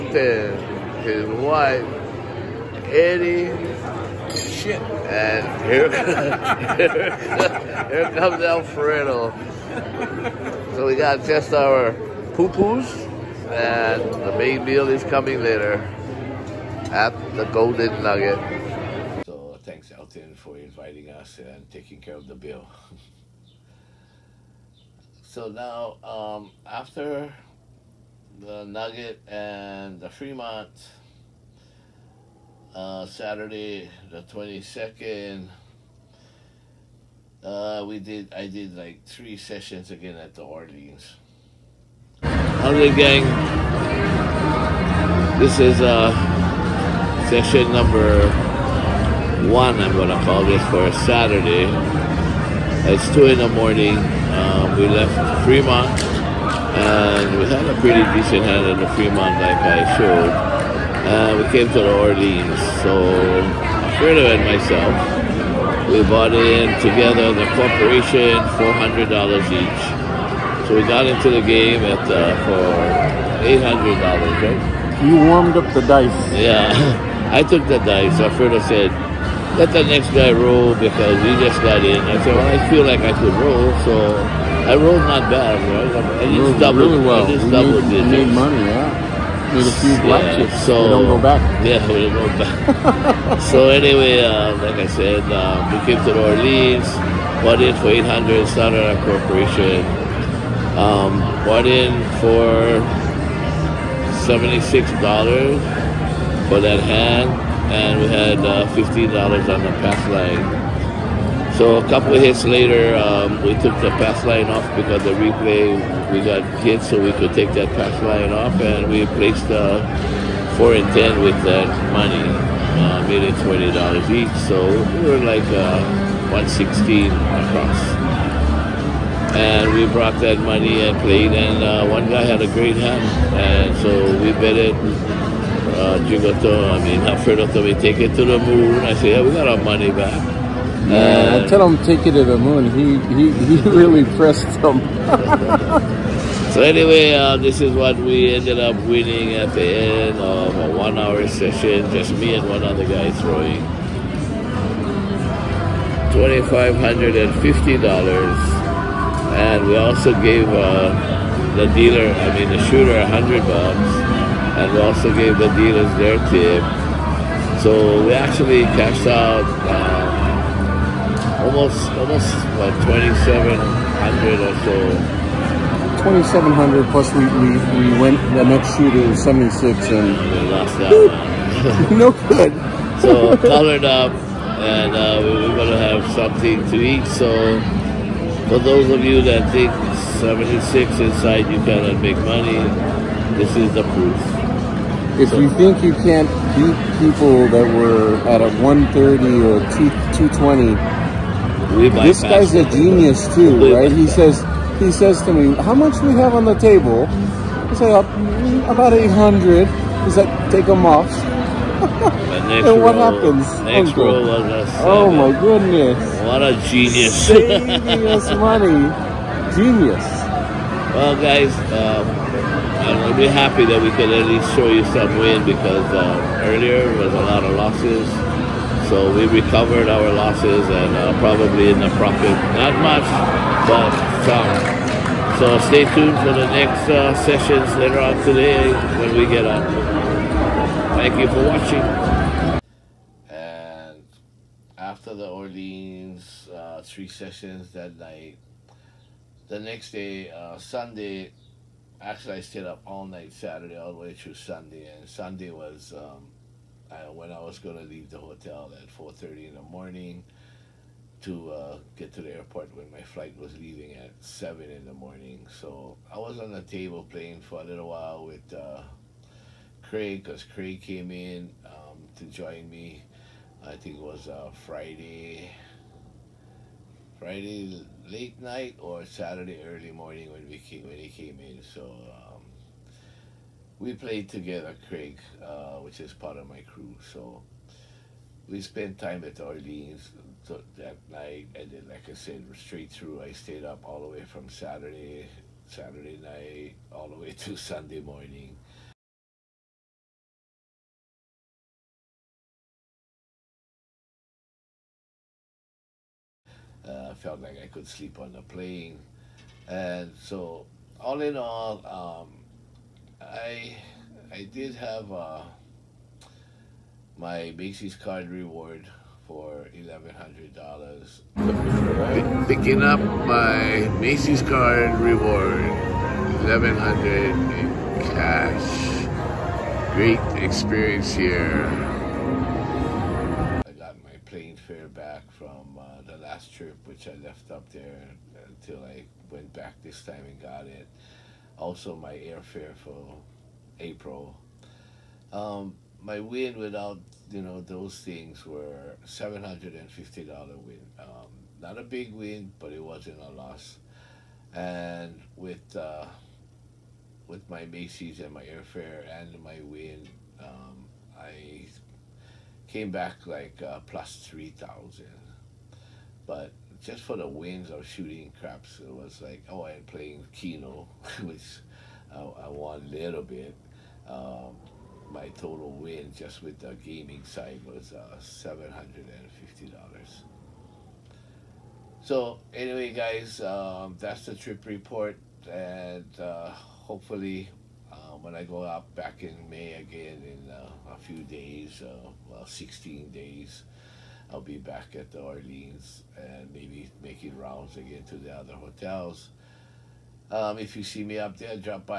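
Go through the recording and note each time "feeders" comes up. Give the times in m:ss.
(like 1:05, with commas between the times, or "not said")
not said.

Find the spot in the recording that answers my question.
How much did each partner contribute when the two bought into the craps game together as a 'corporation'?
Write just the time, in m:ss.
1:08.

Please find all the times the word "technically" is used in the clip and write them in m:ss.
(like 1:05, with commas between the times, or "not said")
not said.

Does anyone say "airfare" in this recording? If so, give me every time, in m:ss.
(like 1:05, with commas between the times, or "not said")
5:42, 5:58.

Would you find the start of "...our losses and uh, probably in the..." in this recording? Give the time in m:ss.
3:49.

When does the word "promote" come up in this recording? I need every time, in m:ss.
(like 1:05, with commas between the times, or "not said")
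not said.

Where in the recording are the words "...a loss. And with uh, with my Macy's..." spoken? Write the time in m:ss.
5:53.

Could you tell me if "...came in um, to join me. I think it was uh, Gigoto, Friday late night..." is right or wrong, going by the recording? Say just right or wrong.
wrong.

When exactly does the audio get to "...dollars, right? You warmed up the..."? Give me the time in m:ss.
1:14.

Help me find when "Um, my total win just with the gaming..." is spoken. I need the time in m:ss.
6:14.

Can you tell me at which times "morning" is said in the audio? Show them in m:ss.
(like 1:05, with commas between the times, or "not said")
0:53, 4:19, 4:24, 4:39, 4:58.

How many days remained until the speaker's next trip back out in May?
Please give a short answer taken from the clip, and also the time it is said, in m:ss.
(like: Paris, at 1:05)
16, at 6:32.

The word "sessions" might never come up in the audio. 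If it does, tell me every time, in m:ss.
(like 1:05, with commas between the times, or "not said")
0:39, 0:47, 2:31, 3:57, 4:07.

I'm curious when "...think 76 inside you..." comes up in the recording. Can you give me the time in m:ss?
3:09.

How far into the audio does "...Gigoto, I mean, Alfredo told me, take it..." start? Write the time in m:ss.
2:16.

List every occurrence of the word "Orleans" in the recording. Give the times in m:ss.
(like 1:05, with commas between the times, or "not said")
0:40, 1:02, 1:36, 4:05, 4:49, 6:35.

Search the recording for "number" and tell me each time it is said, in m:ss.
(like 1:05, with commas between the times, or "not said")
0:47.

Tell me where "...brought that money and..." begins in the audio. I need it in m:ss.
2:09.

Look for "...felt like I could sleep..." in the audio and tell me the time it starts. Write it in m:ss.
5:07.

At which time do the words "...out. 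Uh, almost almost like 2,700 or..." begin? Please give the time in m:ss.
2:49.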